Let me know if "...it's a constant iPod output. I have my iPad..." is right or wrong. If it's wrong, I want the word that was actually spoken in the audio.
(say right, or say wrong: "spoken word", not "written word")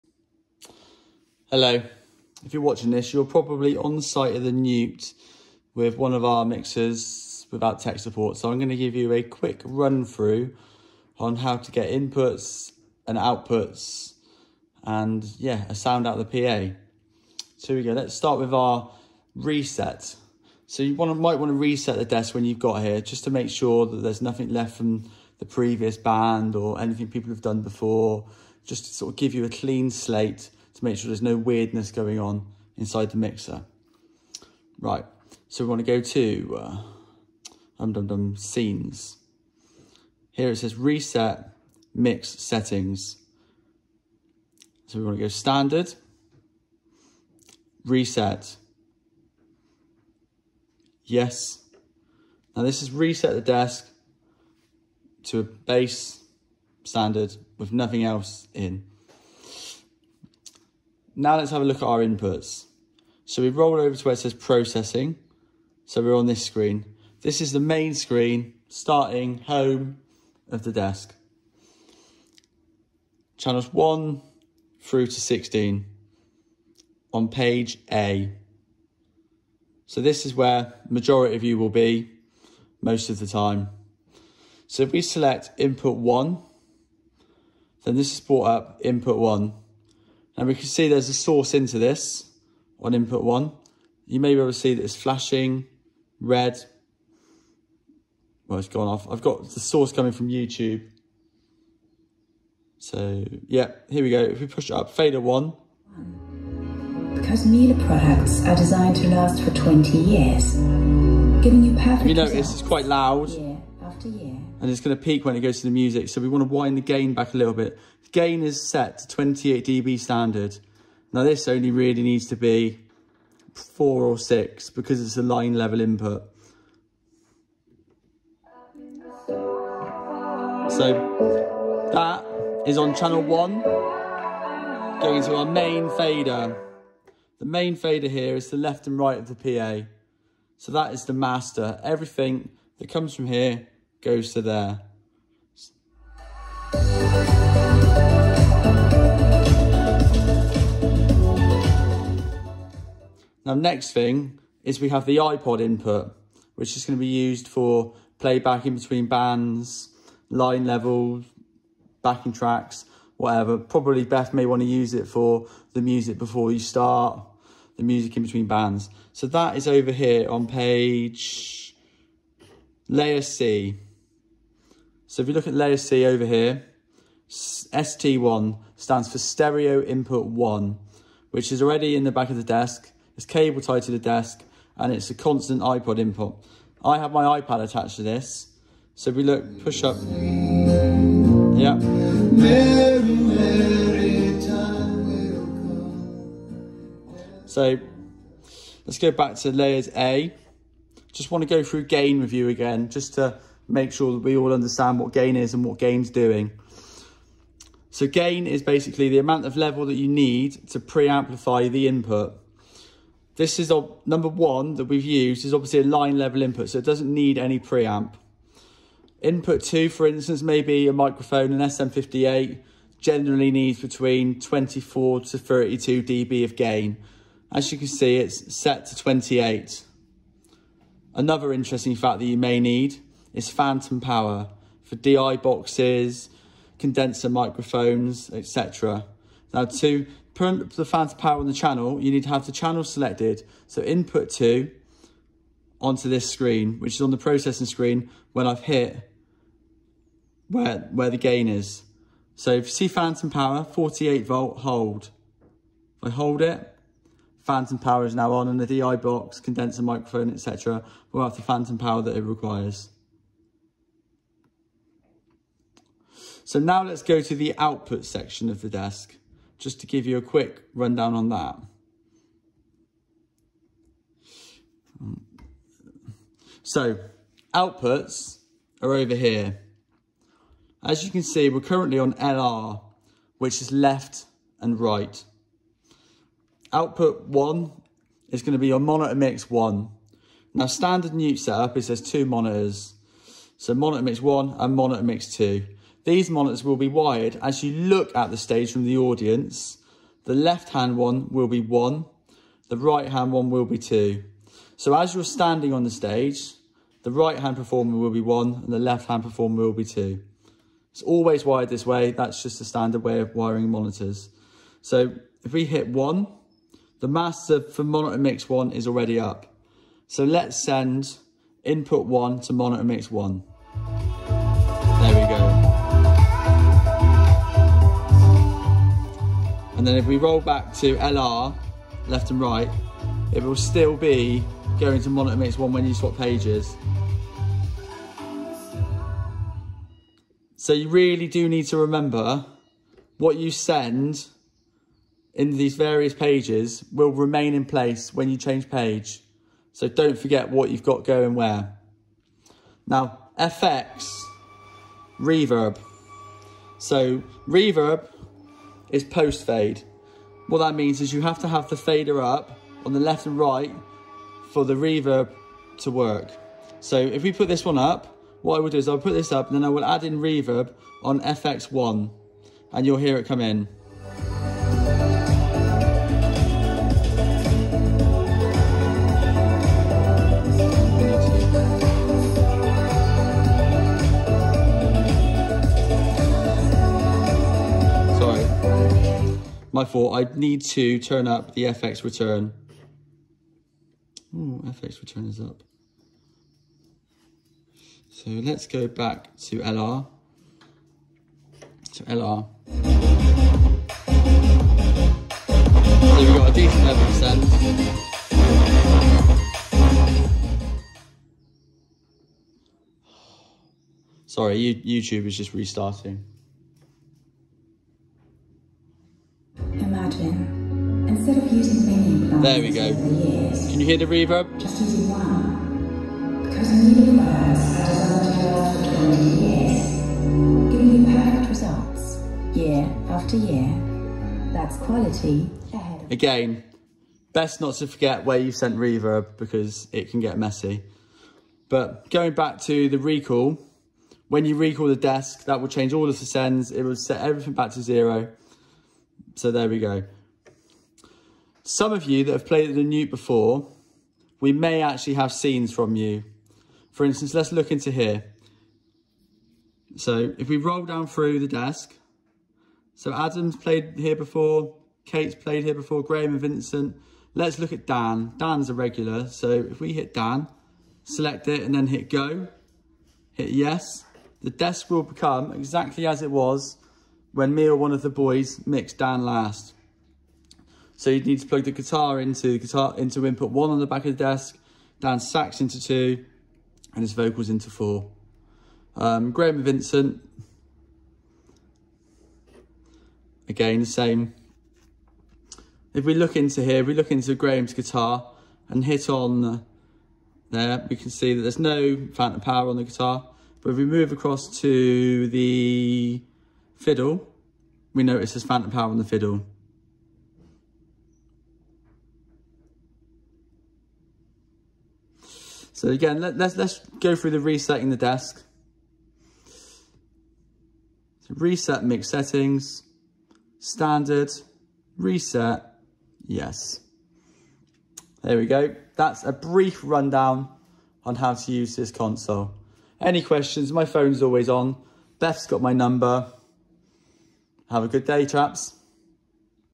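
wrong: "input", not "output".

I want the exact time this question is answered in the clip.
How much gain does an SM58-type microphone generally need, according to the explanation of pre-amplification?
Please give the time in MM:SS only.
03:44.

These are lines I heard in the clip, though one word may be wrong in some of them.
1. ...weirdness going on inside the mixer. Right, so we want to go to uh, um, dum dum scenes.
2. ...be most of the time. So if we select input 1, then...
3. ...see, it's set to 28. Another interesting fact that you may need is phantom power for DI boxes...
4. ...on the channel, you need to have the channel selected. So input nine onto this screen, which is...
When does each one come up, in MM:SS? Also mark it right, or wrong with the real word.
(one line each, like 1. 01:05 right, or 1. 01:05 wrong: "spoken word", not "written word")
1. 00:31 right
2. 01:21 right
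3. 03:47 right
4. 04:01 wrong: "two", not "nine".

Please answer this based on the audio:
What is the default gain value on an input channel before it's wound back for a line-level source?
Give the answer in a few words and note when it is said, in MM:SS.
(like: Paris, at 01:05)
28 dB, at 01:59.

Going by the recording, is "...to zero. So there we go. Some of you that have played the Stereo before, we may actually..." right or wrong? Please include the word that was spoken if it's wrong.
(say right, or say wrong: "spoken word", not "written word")
wrong: "Newt", not "Stereo".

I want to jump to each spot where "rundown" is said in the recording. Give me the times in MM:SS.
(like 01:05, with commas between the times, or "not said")
04:30, 08:49.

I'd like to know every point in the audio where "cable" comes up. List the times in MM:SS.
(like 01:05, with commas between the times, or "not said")
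03:03.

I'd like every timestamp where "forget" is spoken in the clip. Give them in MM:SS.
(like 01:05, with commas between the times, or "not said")
05:50, 07:17.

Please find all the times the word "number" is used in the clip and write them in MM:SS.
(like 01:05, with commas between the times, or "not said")
03:34, 08:55.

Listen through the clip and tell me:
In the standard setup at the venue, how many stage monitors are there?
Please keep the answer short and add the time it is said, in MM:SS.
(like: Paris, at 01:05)
2, at 04:52.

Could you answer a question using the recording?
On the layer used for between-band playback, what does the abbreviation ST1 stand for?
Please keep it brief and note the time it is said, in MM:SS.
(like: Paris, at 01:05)
Stereo Input 1, at 02:59.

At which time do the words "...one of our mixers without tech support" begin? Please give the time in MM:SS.
00:05.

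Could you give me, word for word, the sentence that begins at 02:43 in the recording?
Probably Beth may want to use it for the music before you start, the music in between bands.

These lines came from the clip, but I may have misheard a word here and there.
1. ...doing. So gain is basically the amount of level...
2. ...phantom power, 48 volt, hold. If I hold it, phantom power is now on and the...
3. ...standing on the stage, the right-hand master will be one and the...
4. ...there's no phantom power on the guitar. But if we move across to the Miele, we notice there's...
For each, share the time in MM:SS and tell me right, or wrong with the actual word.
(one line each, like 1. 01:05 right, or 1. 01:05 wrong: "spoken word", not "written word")
1. 03:26 right
2. 04:12 right
3. 05:05 wrong: "performer", not "master"
4. 08:21 wrong: "Fiddle", not "Miele".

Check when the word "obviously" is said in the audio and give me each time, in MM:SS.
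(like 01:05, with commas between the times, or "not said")
03:35.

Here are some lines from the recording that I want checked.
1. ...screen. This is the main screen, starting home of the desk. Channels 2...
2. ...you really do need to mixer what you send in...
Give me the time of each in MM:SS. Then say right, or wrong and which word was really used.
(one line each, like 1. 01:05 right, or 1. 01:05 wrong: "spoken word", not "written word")
1. 01:06 wrong: "1", not "2"
2. 05:40 wrong: "remember", not "mixer".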